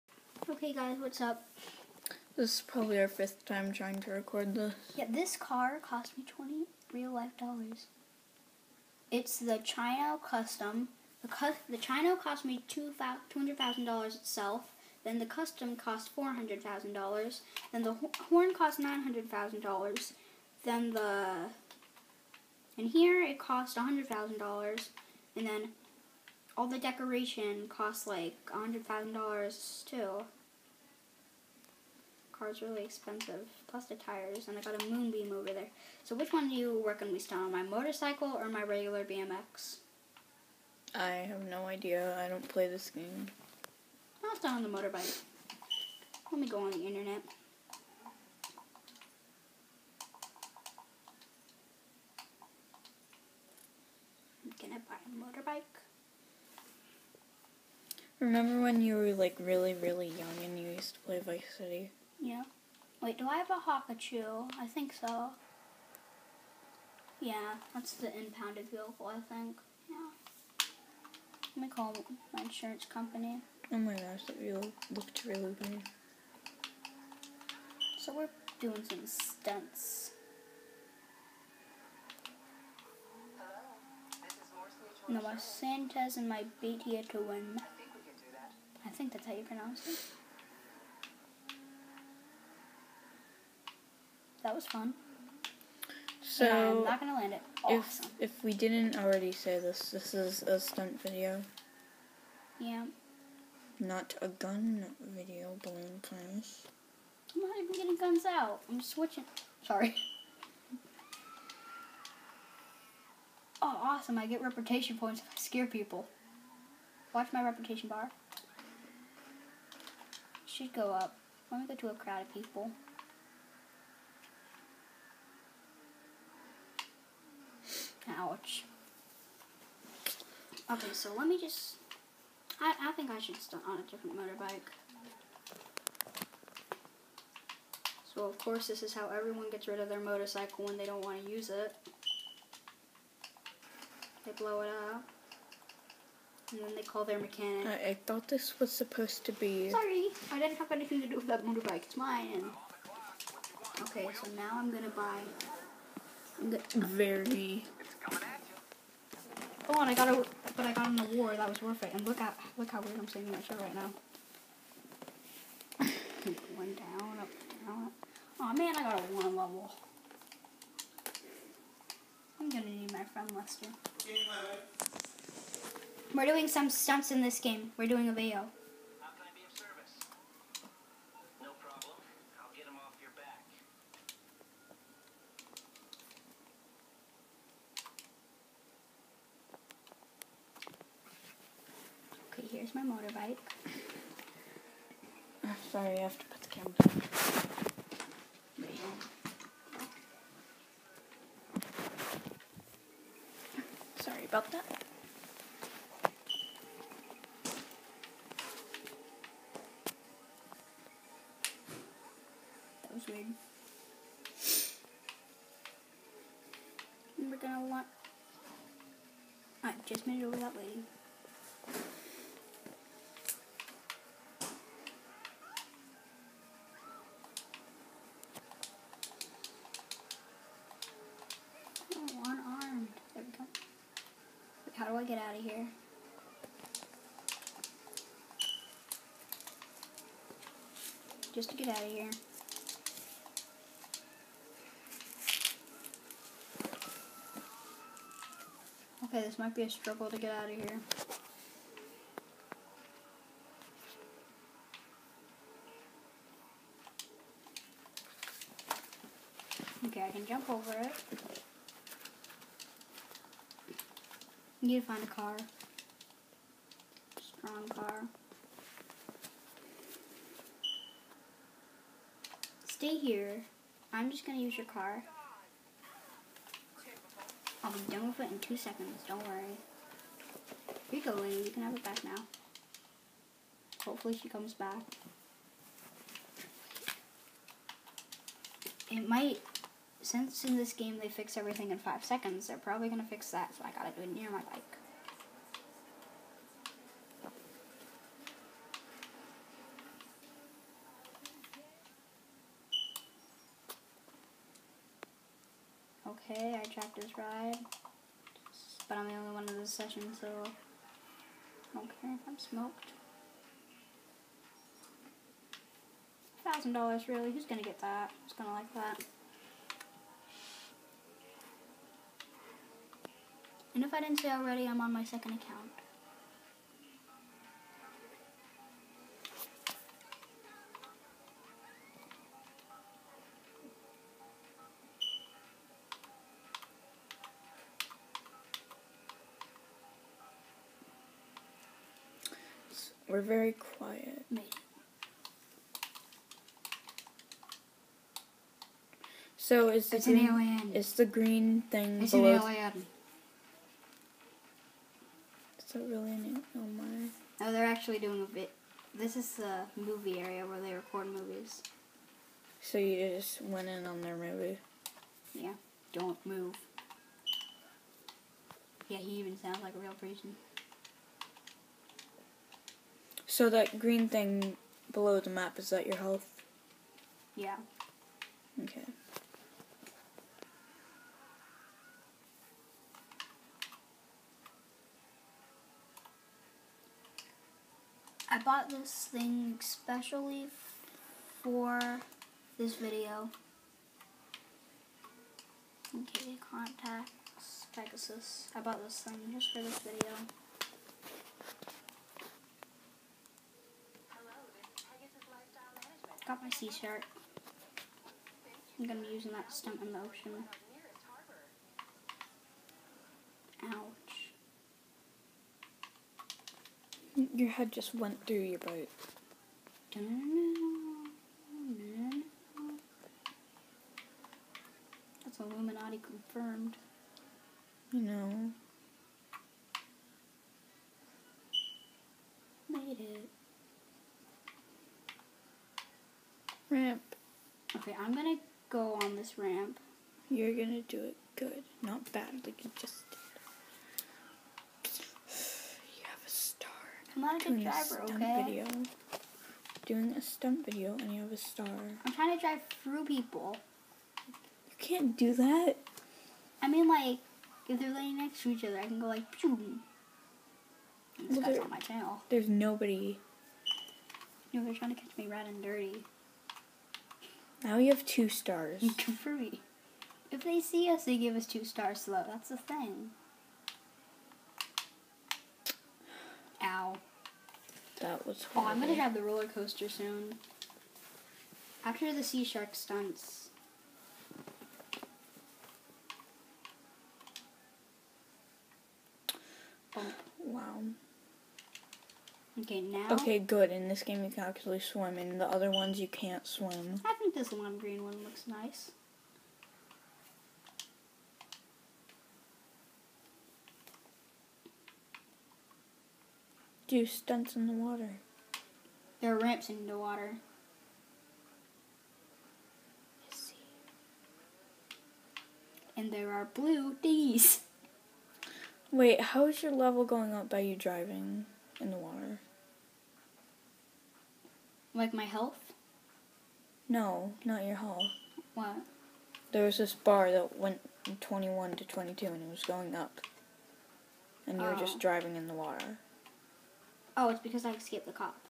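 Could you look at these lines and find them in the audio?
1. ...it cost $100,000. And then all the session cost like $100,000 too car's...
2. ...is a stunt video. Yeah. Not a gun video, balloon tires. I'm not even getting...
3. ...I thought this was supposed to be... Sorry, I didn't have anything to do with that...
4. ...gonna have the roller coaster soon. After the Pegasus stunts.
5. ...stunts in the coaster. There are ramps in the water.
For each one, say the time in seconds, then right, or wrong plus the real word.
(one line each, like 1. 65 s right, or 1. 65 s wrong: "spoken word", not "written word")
1. 23 s wrong: "decoration", not "session"
2. 100 s wrong: "planes", not "tires"
3. 147 s right
4. 478 s wrong: "Seashark", not "Pegasus"
5. 507 s wrong: "water", not "coaster".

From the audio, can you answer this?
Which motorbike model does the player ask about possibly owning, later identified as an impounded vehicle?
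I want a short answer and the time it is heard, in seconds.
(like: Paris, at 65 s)
Hakuchou, at 63 s.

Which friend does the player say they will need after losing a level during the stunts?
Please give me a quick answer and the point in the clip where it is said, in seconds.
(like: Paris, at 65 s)
Lester, at 173 s.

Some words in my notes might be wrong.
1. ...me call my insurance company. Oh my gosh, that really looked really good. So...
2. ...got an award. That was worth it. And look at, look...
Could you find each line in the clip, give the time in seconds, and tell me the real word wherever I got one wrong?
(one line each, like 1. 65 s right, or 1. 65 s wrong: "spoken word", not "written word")
1. 71 s right
2. 160 s right.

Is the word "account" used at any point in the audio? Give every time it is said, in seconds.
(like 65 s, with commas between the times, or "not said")
325 s.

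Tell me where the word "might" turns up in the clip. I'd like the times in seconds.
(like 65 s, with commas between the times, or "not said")
249 s, 289 s.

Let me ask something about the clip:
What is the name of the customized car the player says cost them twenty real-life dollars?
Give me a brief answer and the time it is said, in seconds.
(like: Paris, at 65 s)
Chino Custom, at 9 s.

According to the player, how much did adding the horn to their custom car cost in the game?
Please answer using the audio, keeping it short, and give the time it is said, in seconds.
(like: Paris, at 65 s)
$900,000, at 18 s.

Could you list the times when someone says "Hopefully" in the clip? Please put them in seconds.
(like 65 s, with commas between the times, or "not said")
283 s.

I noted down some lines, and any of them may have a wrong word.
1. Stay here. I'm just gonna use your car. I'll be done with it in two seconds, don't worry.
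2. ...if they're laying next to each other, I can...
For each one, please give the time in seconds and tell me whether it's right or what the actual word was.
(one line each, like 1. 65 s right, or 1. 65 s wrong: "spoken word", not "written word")
1. 272 s right
2. 457 s right.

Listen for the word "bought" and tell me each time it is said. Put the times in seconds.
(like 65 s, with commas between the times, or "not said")
388 s, 398 s.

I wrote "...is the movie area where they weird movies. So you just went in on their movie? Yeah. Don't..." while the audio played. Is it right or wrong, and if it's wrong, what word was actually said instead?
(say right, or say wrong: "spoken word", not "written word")
wrong: "record", not "weird".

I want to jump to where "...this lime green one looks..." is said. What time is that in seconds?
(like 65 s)
497 s.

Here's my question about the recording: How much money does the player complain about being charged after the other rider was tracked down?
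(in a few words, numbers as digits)
$1,000.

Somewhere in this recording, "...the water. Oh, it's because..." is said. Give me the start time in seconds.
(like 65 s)
535 s.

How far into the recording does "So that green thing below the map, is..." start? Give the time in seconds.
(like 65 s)
373 s.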